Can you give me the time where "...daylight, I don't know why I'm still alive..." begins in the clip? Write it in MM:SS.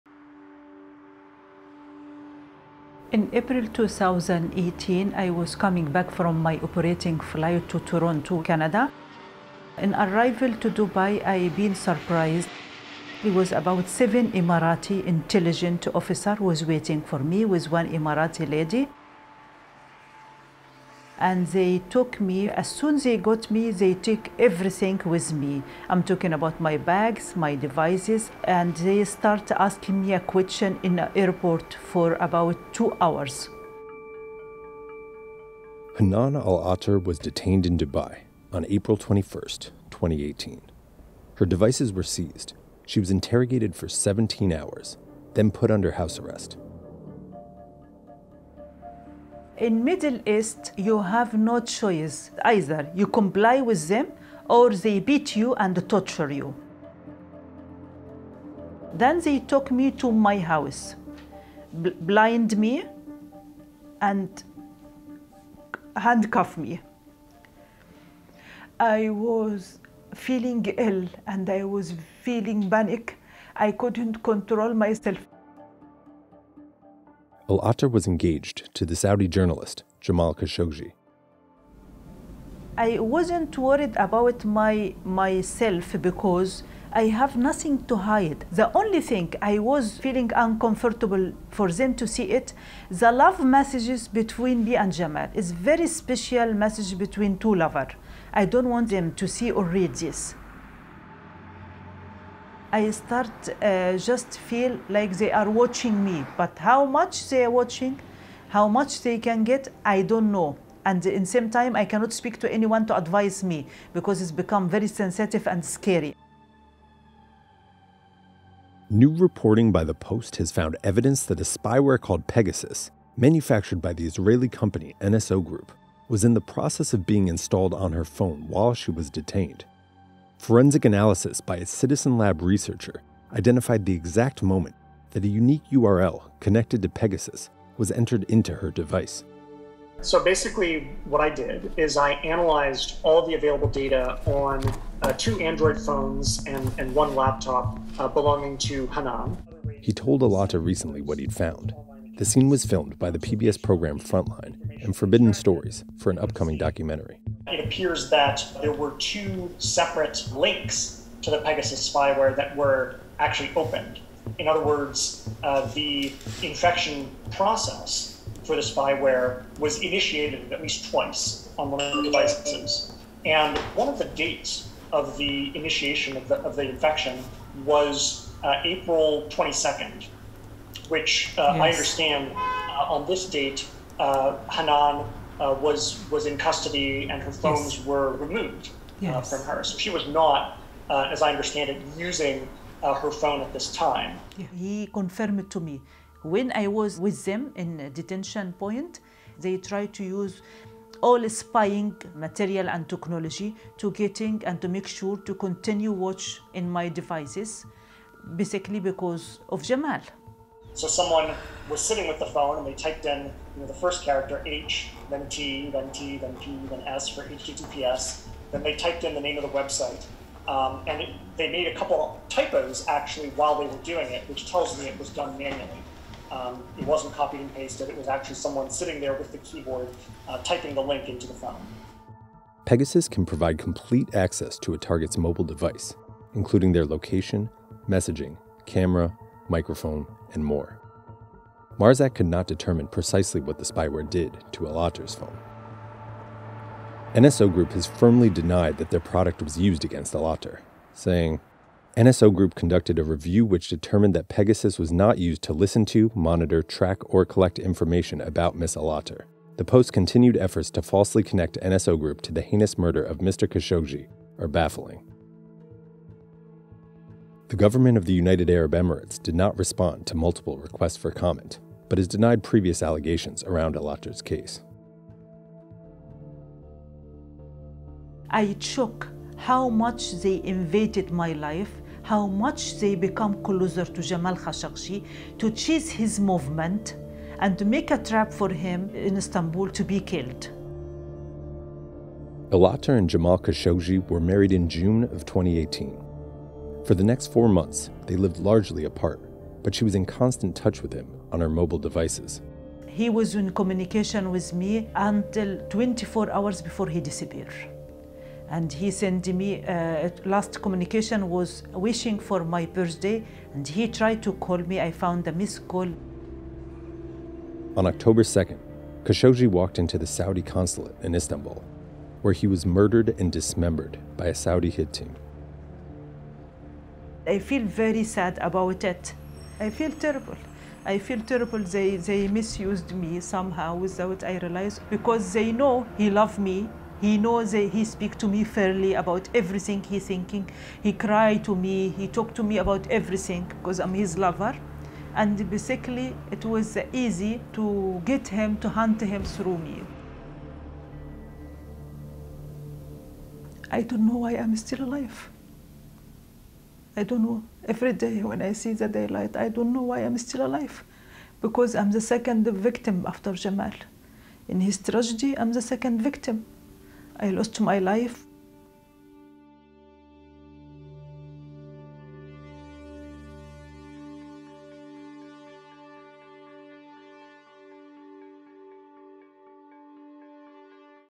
05:58.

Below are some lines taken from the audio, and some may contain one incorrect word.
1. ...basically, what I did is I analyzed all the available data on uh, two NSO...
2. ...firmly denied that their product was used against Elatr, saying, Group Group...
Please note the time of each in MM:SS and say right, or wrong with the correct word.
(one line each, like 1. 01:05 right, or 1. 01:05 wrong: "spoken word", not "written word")
1. 02:20 wrong: "Android", not "NSO"
2. 04:07 wrong: "NSO", not "Group".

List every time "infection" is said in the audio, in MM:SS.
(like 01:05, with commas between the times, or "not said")
02:46, 02:56.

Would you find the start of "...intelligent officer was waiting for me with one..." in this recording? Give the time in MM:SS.
00:15.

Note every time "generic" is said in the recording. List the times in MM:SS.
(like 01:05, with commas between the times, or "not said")
not said.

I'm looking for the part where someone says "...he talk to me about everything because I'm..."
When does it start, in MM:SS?
05:41.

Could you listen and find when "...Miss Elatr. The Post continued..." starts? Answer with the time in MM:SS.
04:18.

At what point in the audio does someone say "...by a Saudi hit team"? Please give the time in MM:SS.
05:24.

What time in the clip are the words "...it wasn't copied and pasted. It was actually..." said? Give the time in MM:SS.
03:46.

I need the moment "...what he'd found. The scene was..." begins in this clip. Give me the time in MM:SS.
02:31.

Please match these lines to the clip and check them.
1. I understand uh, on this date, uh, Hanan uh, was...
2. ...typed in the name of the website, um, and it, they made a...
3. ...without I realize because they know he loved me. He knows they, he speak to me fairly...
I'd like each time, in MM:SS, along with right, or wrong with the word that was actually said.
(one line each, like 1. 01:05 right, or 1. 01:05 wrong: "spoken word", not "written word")
1. 03:01 right
2. 03:38 right
3. 05:33 right.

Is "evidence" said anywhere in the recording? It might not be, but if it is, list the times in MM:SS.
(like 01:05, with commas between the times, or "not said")
02:00.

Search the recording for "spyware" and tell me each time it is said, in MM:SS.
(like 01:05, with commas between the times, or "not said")
02:01, 02:41, 02:48, 04:03.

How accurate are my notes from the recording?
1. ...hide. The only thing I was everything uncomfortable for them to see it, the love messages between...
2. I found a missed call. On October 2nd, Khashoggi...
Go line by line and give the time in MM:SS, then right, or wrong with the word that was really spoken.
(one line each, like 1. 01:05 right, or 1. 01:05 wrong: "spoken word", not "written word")
1. 01:27 wrong: "feeling", not "everything"
2. 05:14 right.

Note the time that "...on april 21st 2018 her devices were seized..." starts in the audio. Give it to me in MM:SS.
00:38.